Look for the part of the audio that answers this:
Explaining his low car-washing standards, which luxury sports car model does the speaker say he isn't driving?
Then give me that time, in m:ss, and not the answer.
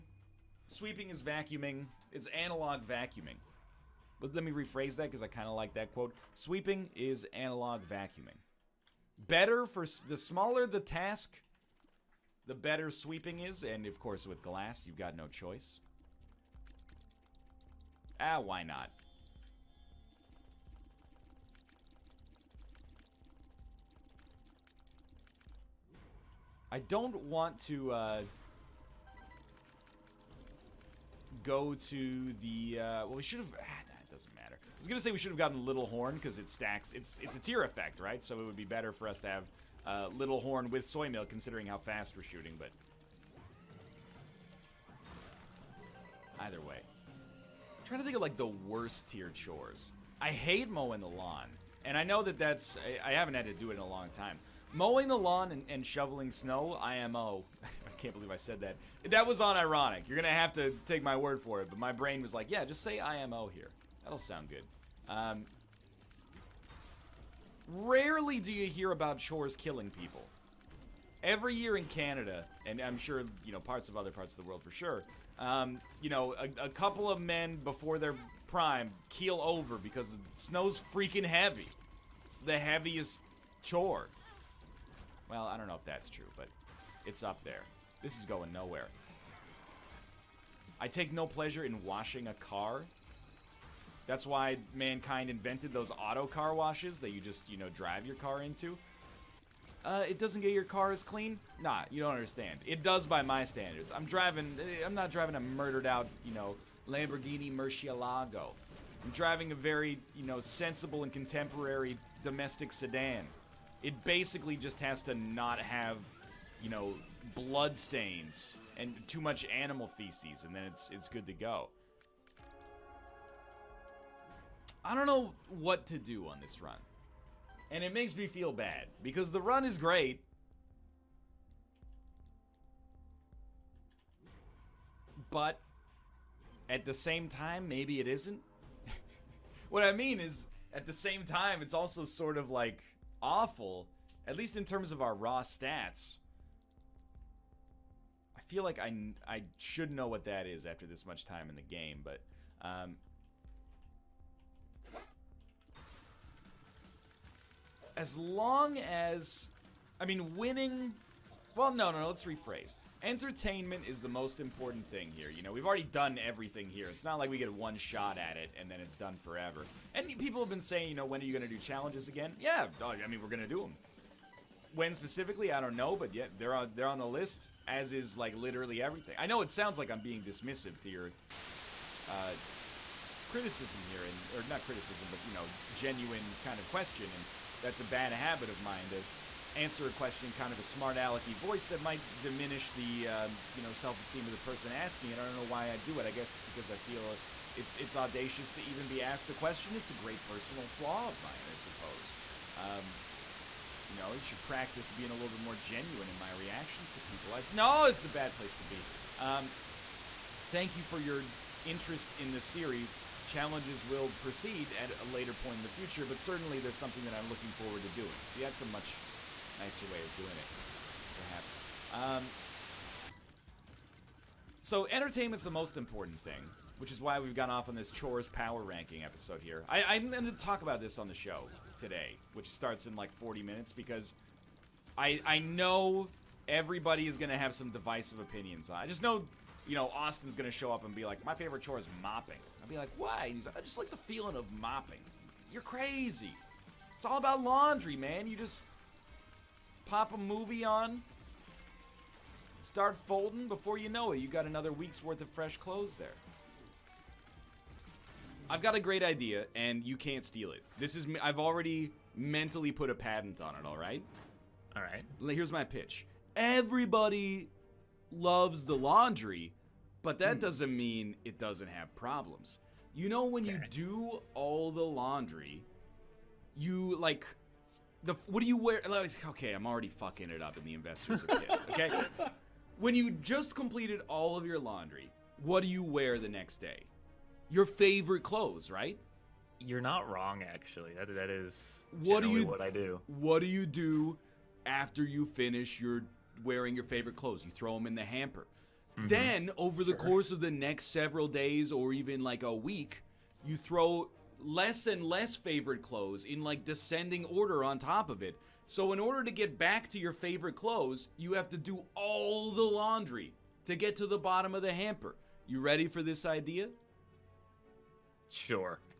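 1:46.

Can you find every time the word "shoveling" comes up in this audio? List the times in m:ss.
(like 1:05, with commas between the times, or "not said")
0:55.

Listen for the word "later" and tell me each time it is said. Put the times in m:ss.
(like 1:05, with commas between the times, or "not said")
3:35.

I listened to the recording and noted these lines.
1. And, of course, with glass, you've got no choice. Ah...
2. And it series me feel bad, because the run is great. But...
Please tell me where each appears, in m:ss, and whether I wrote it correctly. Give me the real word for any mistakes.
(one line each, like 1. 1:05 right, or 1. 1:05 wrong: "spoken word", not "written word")
1. 0:13 right
2. 2:07 wrong: "makes", not "series".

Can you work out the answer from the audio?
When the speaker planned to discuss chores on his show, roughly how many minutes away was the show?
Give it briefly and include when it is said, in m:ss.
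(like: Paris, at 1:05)
40, at 3:53.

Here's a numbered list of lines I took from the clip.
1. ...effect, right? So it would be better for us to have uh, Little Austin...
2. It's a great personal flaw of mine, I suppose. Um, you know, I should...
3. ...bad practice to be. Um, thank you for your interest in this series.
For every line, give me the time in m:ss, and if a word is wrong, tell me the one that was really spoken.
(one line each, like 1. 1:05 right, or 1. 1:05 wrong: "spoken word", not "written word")
1. 0:37 wrong: "Horn", not "Austin"
2. 3:19 right
3. 3:28 wrong: "place", not "practice".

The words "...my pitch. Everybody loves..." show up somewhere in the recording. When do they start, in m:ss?
4:25.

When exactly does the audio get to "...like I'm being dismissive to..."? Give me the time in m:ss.
2:59.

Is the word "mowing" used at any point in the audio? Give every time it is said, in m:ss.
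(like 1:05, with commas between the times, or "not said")
0:50, 0:54.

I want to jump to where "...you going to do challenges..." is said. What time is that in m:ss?
2:51.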